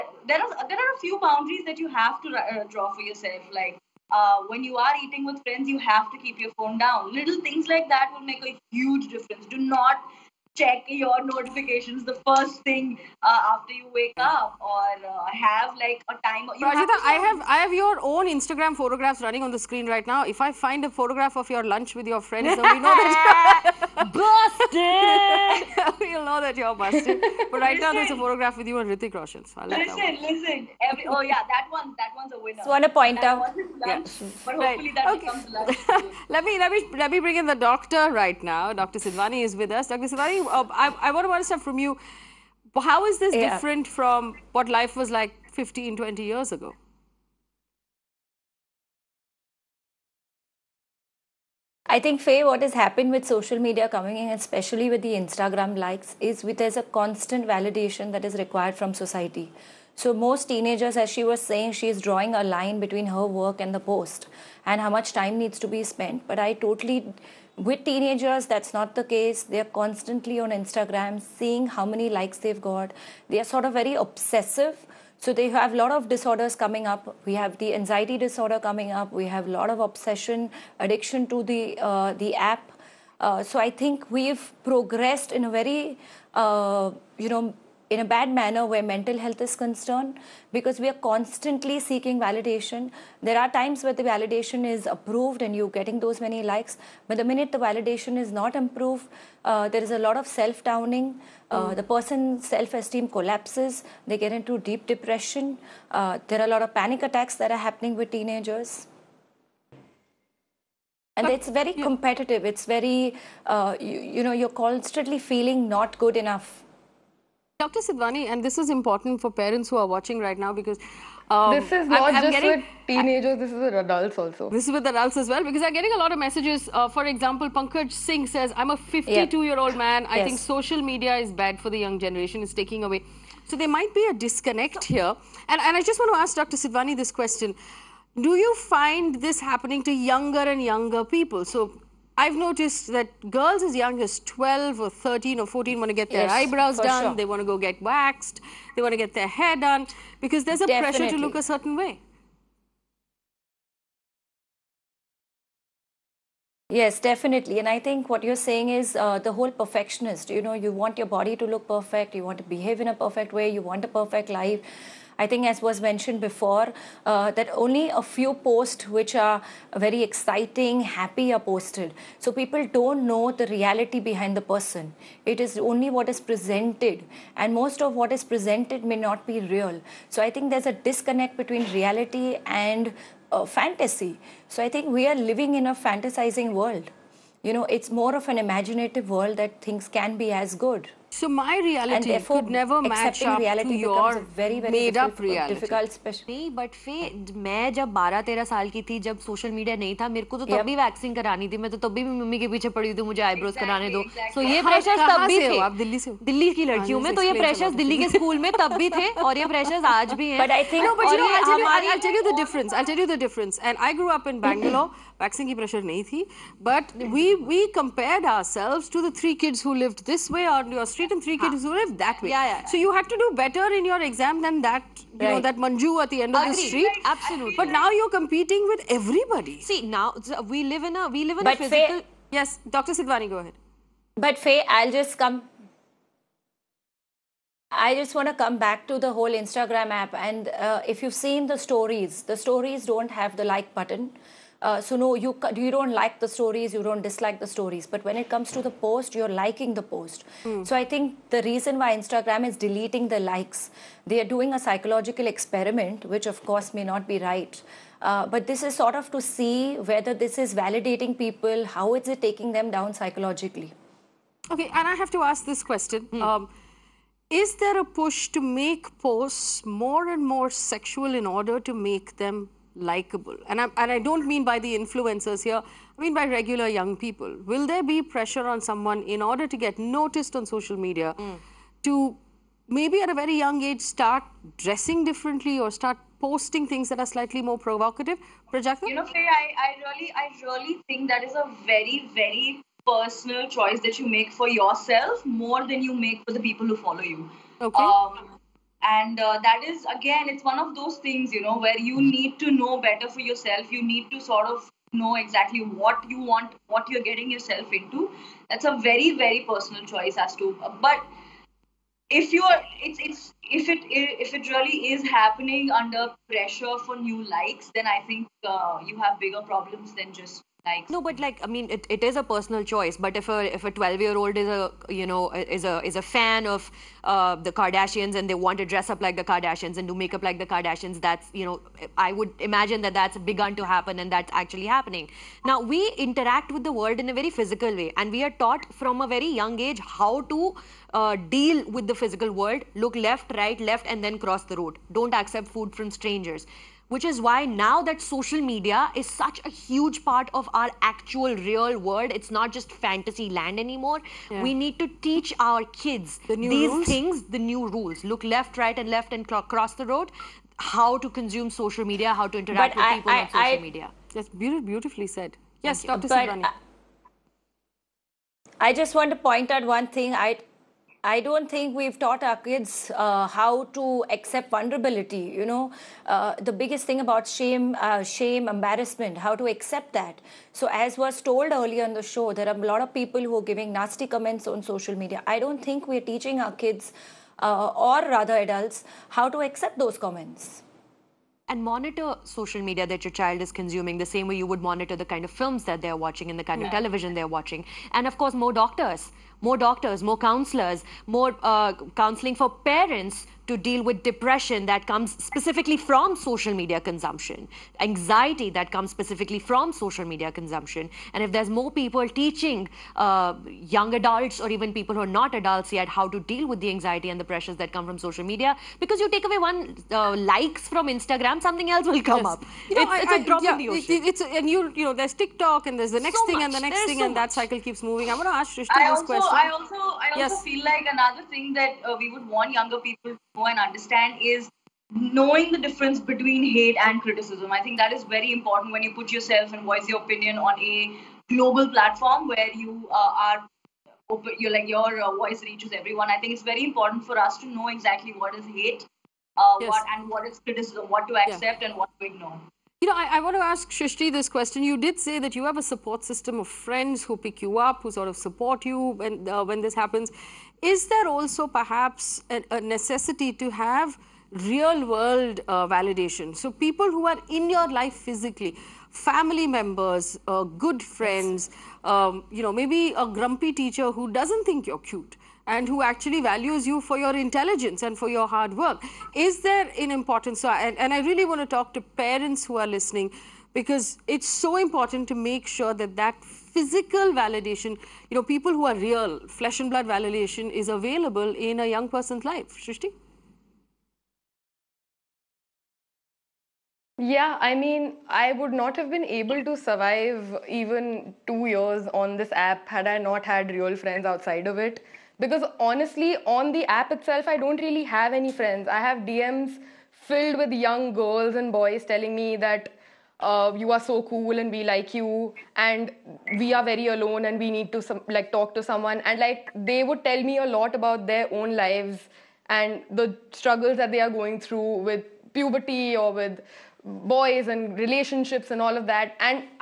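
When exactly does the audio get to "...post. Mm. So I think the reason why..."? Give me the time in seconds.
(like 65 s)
249 s.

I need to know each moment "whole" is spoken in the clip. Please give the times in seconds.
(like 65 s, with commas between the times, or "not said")
159 s, 239 s.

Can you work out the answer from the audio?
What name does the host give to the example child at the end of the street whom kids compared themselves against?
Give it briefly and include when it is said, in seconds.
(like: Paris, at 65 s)
Manju, at 225 s.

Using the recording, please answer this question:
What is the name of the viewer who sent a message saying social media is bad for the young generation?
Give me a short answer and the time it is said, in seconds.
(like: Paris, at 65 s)
Pankaj Singh, at 127 s.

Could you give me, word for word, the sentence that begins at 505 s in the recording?
Because honestly, on the app itself, I don't really have any friends.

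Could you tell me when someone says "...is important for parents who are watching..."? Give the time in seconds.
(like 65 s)
118 s.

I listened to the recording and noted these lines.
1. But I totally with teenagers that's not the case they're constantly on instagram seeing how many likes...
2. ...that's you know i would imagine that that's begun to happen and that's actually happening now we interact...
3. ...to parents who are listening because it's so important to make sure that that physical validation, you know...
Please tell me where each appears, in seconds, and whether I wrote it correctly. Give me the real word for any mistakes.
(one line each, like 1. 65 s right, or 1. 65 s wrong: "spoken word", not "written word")
1. 66 s right
2. 331 s right
3. 481 s right.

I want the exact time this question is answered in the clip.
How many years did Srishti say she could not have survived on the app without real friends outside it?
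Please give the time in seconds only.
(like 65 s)
501 s.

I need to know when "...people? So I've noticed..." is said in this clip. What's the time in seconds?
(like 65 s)
141 s.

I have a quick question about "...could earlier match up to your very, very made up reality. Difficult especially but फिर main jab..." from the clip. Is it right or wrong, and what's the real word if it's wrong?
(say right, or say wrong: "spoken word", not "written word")
wrong: "never", not "earlier".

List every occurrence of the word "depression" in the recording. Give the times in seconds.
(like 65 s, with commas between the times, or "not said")
104 s, 404 s.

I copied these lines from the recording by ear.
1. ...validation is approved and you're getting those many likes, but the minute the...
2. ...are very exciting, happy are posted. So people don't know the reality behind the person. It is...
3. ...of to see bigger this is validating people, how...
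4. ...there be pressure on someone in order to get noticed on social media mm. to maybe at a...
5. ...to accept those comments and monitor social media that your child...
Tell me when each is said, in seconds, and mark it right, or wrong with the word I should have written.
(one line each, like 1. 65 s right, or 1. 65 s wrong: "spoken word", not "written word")
1. 94 s right
2. 169 s right
3. 258 s wrong: "whether", not "bigger"
4. 277 s right
5. 389 s right.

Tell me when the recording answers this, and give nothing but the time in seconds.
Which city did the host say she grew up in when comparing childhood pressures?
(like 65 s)
214 s.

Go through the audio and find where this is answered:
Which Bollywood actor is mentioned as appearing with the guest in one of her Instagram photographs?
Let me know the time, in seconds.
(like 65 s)
28 s.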